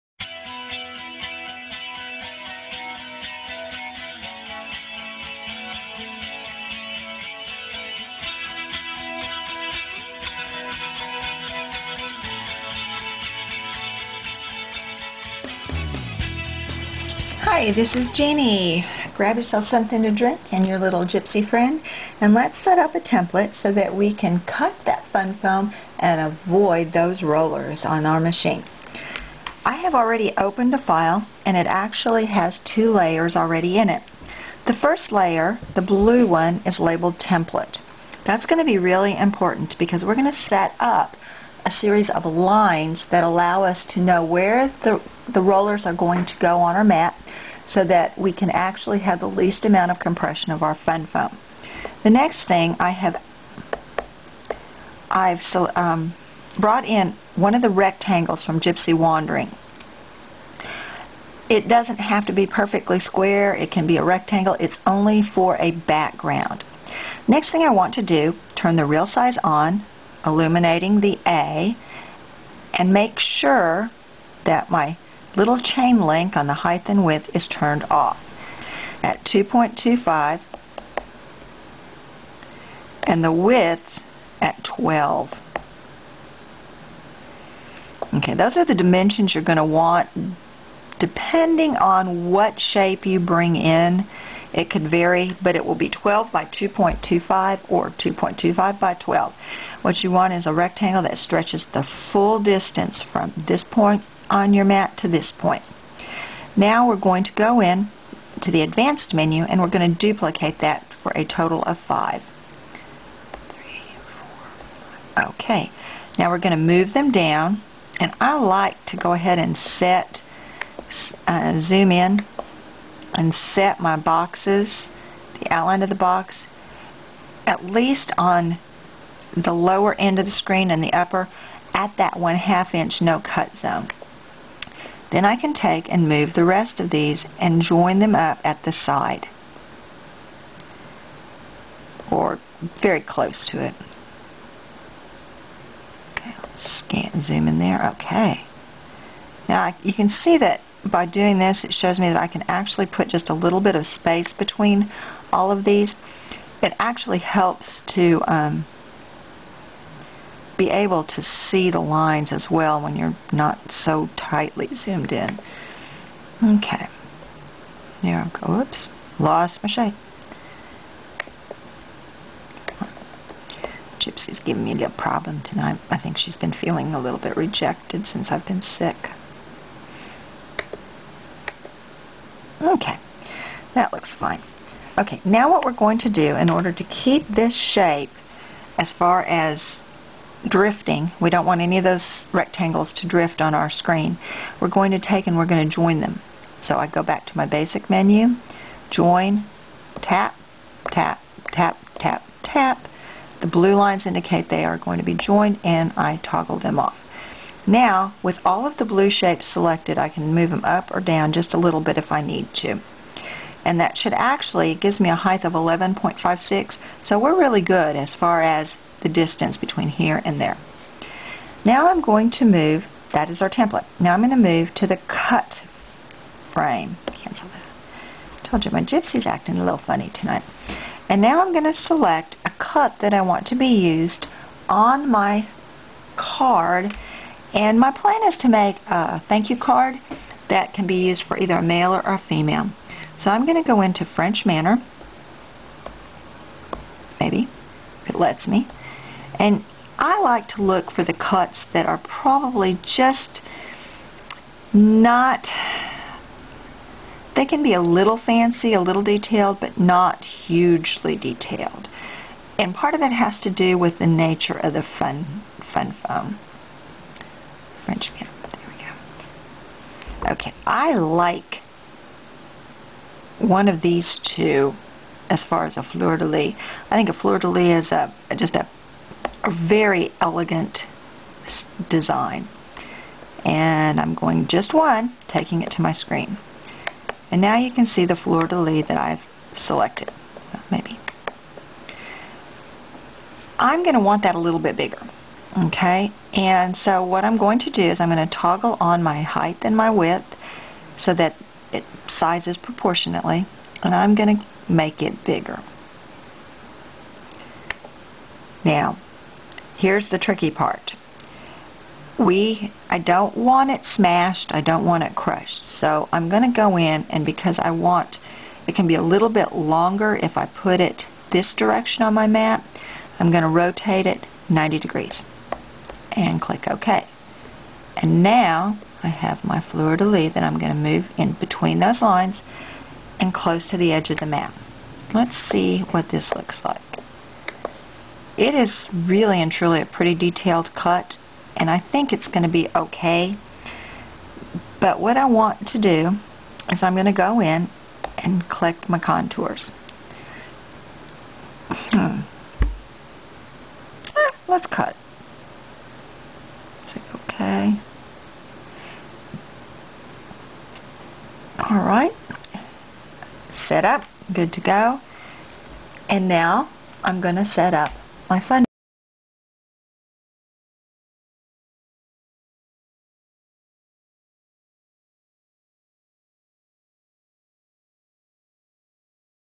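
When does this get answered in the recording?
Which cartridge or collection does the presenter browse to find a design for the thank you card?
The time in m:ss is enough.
4:04.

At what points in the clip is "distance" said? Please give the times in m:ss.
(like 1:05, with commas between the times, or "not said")
1:42, 3:39.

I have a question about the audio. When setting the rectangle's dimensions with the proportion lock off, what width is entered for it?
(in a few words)
12.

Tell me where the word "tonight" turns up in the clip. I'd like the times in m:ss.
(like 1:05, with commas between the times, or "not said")
2:55, 3:50.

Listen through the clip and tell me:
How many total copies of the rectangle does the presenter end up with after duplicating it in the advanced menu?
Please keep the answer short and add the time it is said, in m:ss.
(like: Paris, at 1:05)
5, at 1:51.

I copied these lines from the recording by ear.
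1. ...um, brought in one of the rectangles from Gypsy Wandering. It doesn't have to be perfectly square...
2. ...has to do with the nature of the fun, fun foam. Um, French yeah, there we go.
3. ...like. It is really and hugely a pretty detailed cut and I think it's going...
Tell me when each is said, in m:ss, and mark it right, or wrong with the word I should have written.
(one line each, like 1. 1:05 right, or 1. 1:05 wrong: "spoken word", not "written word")
1. 0:55 right
2. 4:23 right
3. 5:36 wrong: "truly", not "hugely".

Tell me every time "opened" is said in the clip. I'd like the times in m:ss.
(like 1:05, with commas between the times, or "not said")
0:30.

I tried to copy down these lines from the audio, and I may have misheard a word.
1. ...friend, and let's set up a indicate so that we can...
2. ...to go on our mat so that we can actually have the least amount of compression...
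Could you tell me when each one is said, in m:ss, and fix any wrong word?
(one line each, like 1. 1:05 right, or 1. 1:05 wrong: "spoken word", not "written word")
1. 0:21 wrong: "template", not "indicate"
2. 0:46 right.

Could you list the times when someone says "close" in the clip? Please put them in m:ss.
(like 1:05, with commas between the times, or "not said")
2:23, 5:33.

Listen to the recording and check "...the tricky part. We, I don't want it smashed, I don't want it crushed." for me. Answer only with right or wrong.
right.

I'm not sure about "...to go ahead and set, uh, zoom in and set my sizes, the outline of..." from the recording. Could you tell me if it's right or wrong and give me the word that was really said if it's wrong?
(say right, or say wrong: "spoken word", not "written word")
wrong: "boxes", not "sizes".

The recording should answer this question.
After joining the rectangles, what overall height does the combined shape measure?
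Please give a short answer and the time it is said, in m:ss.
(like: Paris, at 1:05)
11.56, at 3:35.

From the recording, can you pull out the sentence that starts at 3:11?
We don't want any of those rectangles to drift on our screen.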